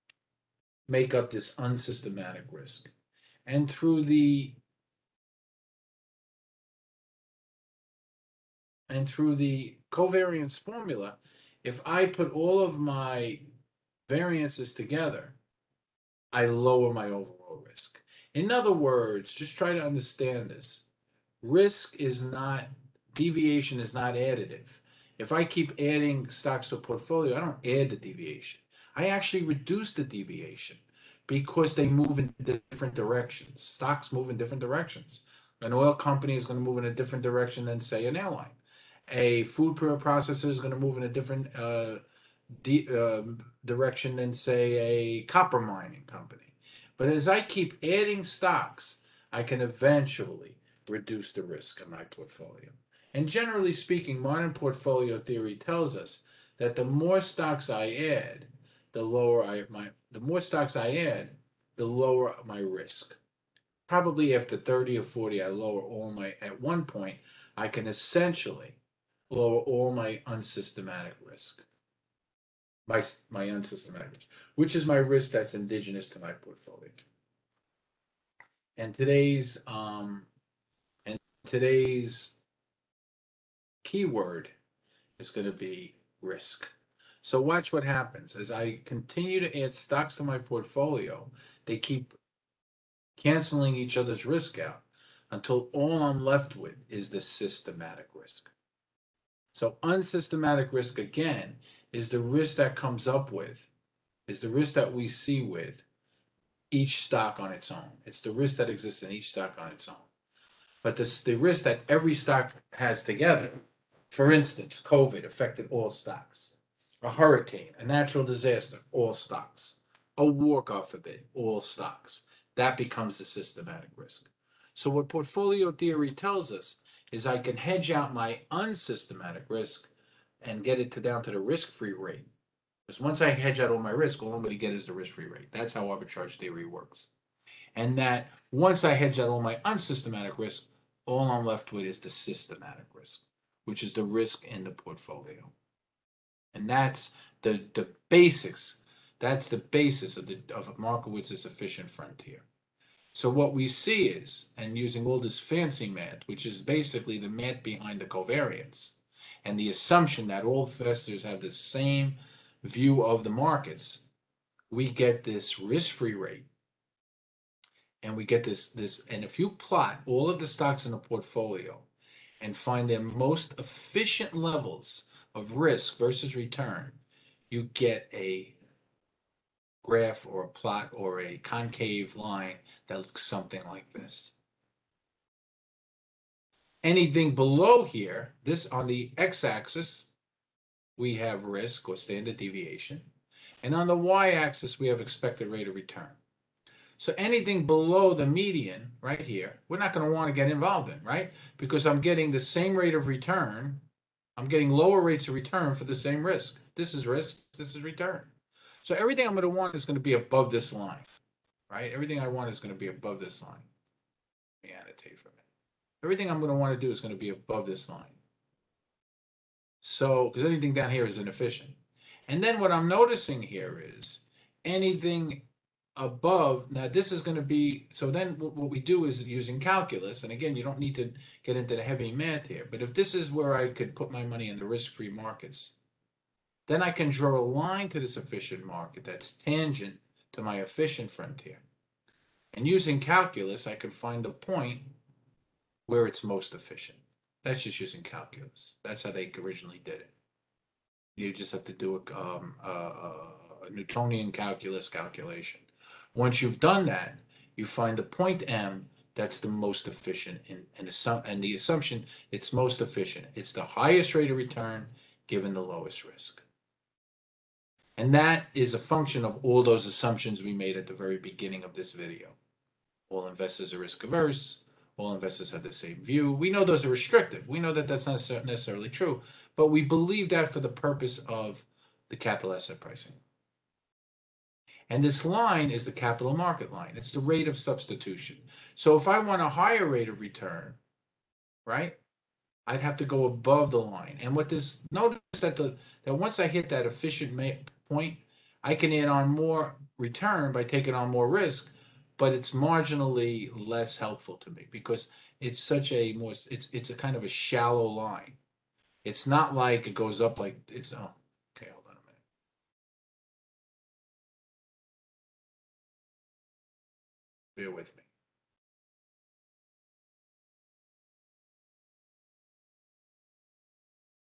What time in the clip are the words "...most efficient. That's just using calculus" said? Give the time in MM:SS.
04:06.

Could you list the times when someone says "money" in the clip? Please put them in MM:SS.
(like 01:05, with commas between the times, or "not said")
03:54.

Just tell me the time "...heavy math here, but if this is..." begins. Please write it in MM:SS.
03:51.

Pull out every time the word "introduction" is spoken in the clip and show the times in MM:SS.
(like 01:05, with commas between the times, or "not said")
not said.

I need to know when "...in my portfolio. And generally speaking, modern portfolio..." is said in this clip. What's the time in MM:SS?
00:51.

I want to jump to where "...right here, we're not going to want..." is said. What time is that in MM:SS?
03:18.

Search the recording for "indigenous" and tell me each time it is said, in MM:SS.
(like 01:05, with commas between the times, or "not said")
01:15.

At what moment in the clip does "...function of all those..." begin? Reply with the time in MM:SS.
04:28.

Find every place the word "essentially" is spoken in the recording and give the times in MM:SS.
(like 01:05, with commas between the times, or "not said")
01:07.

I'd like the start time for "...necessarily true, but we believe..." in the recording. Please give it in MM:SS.
04:38.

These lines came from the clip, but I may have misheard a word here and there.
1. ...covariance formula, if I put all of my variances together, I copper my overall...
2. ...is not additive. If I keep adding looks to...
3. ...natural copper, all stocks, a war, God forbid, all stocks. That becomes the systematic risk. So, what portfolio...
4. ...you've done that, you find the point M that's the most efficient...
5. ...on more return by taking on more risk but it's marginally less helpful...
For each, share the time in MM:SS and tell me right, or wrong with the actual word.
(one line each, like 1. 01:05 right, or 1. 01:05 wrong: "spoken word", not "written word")
1. 00:09 wrong: "lower", not "copper"
2. 00:23 wrong: "stocks", not "looks"
3. 01:57 wrong: "disaster", not "copper"
4. 04:16 right
5. 04:59 right.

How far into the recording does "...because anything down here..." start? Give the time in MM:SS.
03:40.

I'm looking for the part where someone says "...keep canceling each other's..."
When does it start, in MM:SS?
01:31.